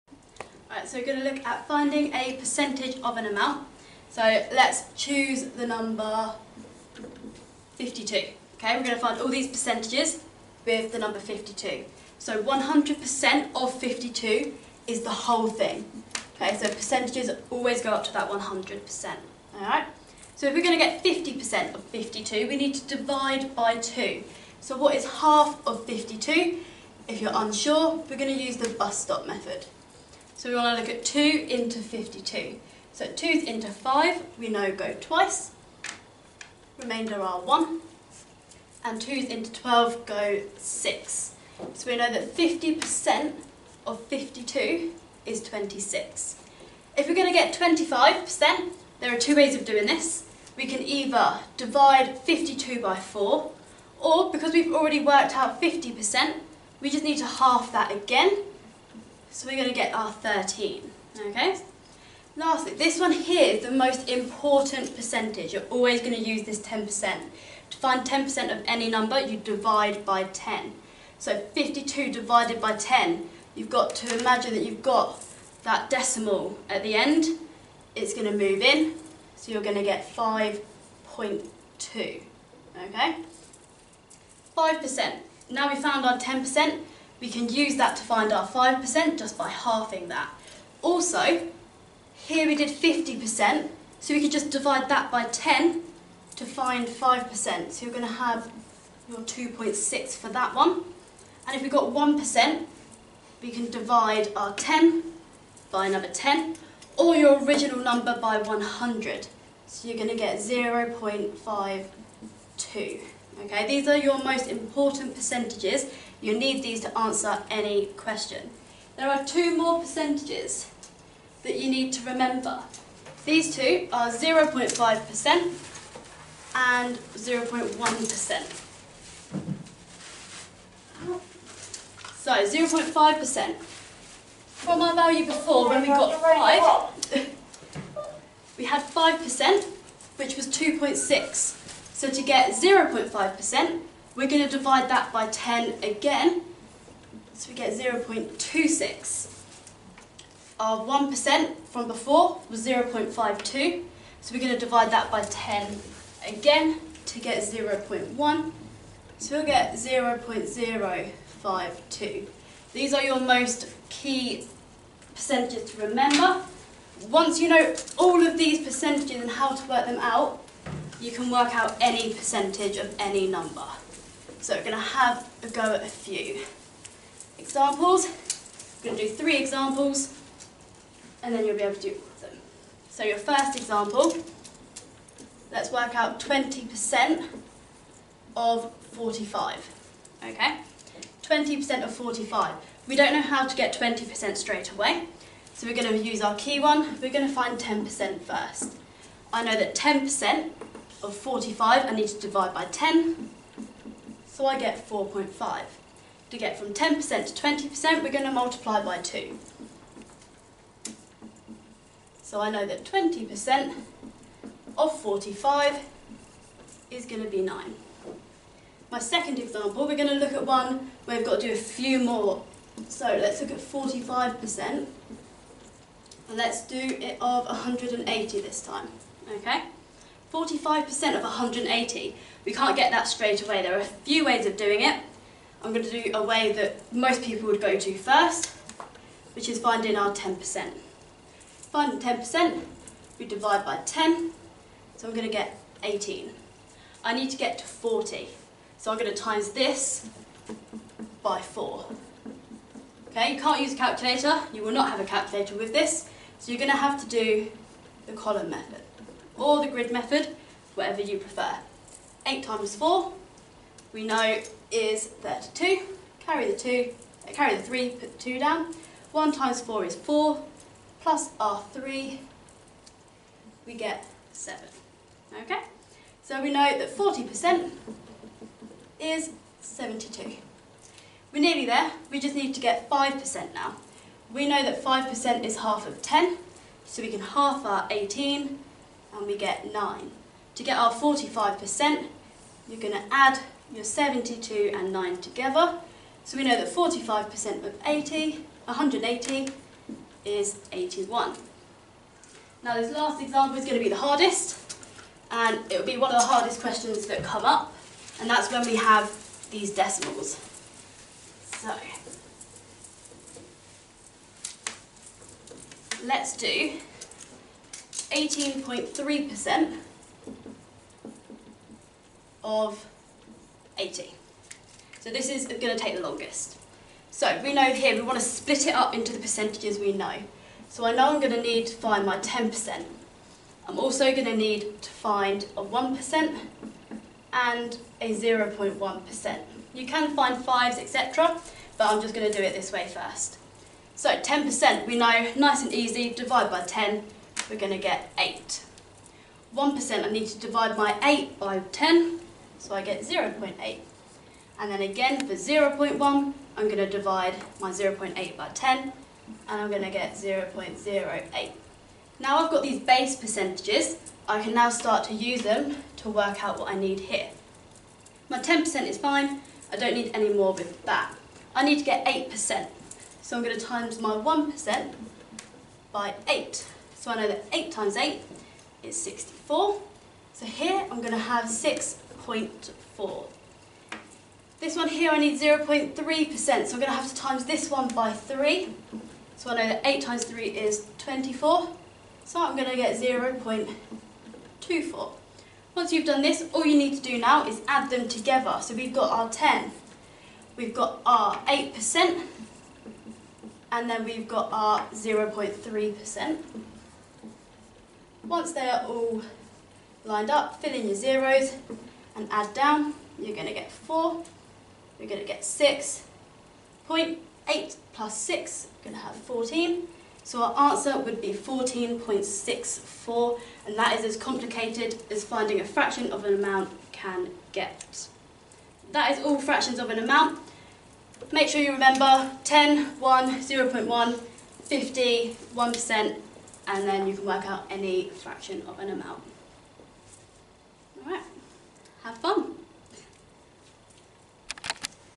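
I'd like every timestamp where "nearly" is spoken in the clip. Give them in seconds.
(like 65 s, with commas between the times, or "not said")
281 s.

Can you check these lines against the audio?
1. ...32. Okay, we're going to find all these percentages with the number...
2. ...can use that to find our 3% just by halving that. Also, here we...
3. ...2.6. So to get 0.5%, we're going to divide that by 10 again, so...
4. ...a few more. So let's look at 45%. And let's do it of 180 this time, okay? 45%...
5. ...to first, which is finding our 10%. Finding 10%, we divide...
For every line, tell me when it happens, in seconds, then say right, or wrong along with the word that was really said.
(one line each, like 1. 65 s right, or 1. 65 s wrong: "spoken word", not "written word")
1. 7 s wrong: "52", not "32"
2. 87 s wrong: "5", not "3"
3. 140 s right
4. 221 s right
5. 237 s right.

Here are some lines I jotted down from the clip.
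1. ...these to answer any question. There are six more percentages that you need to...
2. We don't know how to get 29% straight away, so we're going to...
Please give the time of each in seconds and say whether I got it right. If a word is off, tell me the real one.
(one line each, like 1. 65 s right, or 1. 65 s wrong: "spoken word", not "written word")
1. 116 s wrong: "two", not "six"
2. 192 s wrong: "20", not "29".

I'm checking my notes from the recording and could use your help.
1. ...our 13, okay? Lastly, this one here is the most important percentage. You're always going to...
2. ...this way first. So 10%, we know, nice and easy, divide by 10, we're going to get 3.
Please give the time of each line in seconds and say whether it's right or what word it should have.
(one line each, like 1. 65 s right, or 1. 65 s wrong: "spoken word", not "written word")
1. 59 s right
2. 342 s wrong: "8", not "3".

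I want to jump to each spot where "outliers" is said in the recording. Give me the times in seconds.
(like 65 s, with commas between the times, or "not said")
not said.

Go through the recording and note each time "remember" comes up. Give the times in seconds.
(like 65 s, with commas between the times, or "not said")
122 s, 165 s, 431 s.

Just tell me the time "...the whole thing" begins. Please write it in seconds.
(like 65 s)
15 s.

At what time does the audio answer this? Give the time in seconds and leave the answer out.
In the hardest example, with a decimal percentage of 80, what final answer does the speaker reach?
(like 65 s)
421 s.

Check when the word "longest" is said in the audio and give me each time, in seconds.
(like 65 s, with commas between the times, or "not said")
326 s.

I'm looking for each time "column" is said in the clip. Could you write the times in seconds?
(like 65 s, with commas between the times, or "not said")
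258 s.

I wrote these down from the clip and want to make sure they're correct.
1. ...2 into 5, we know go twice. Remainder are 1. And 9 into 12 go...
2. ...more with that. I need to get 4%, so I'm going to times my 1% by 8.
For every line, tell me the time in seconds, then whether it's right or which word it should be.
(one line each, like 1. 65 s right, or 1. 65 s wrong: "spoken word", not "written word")
1. 33 s wrong: "2", not "9"
2. 370 s wrong: "8", not "4".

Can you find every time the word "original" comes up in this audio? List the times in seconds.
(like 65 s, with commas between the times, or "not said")
107 s.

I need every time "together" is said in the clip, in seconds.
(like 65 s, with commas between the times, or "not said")
295 s, 398 s.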